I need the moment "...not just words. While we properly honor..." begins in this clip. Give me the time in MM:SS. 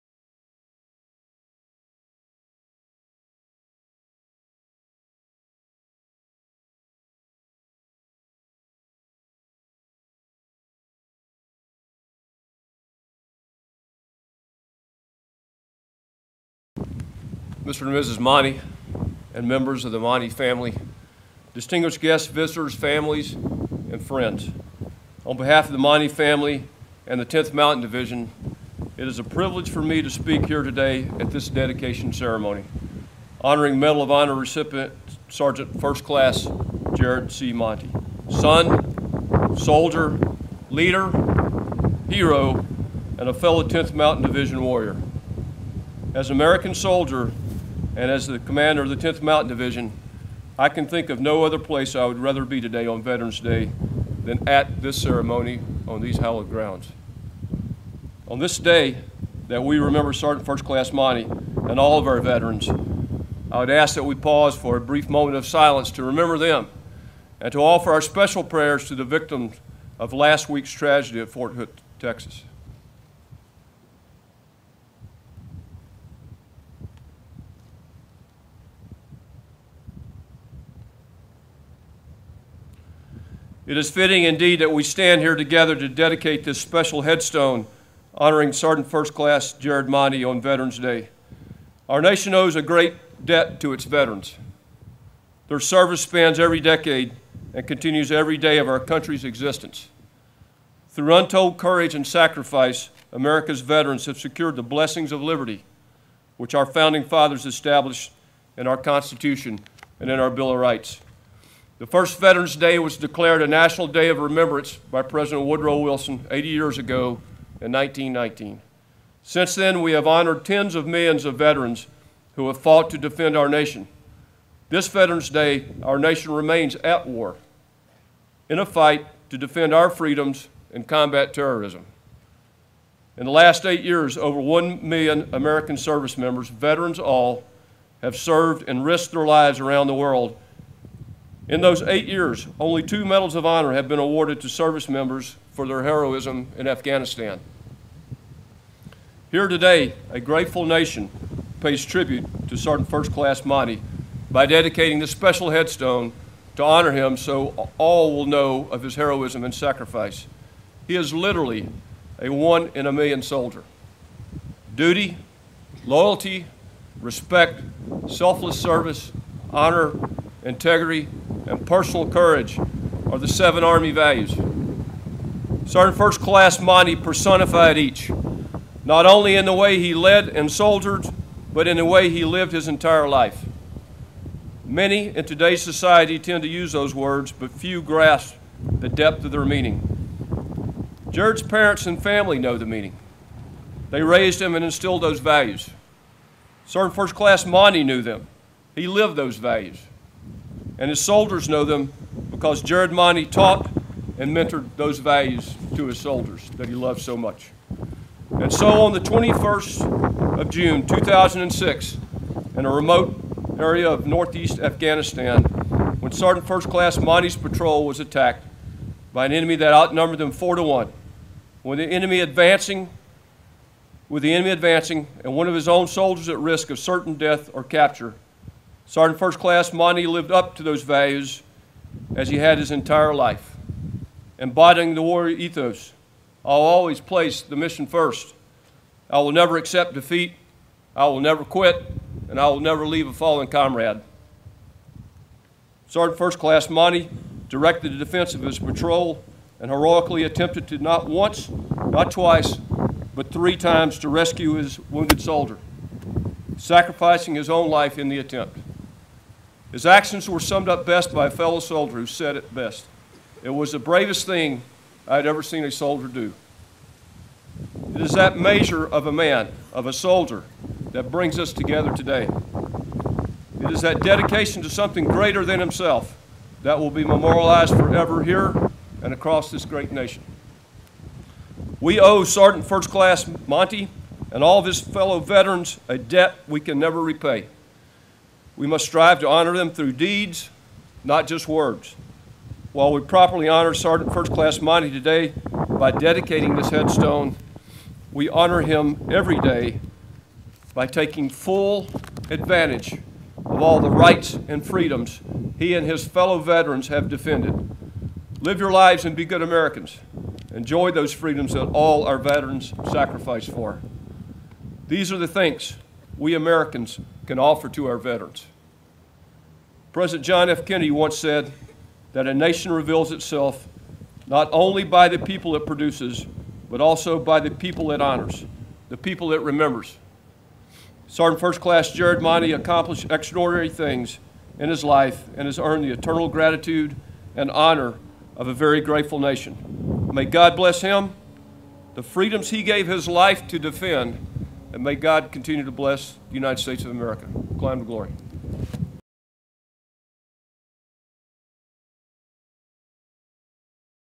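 04:51.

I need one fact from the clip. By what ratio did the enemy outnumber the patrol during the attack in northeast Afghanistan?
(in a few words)
4 to 1.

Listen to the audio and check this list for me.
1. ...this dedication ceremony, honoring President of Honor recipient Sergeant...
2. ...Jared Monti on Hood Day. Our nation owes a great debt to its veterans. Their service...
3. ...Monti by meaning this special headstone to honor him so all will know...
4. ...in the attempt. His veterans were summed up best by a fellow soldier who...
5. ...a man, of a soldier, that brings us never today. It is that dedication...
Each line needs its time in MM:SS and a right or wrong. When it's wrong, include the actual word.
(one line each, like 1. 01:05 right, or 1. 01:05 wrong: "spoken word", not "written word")
1. 00:31 wrong: "Medal", not "President"
2. 01:29 wrong: "Veterans", not "Hood"
3. 02:33 wrong: "dedicating", not "meaning"
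4. 04:17 wrong: "actions", not "veterans"
5. 04:29 wrong: "together", not "never".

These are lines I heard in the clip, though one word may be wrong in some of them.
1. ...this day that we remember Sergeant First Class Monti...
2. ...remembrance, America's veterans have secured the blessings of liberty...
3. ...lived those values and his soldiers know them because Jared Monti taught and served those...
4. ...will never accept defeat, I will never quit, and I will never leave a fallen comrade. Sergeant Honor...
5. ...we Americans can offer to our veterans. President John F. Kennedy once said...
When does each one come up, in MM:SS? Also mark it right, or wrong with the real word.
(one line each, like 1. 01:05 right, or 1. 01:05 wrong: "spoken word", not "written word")
1. 00:58 right
2. 01:42 wrong: "sacrifice", not "remembrance"
3. 03:18 wrong: "mentored", not "served"
4. 03:59 wrong: "First", not "Honor"
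5. 05:16 right.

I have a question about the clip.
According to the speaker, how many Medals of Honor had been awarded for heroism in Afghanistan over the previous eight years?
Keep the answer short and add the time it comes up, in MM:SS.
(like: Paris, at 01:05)
2, at 02:22.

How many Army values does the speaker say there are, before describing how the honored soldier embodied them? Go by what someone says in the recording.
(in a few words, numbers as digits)
7.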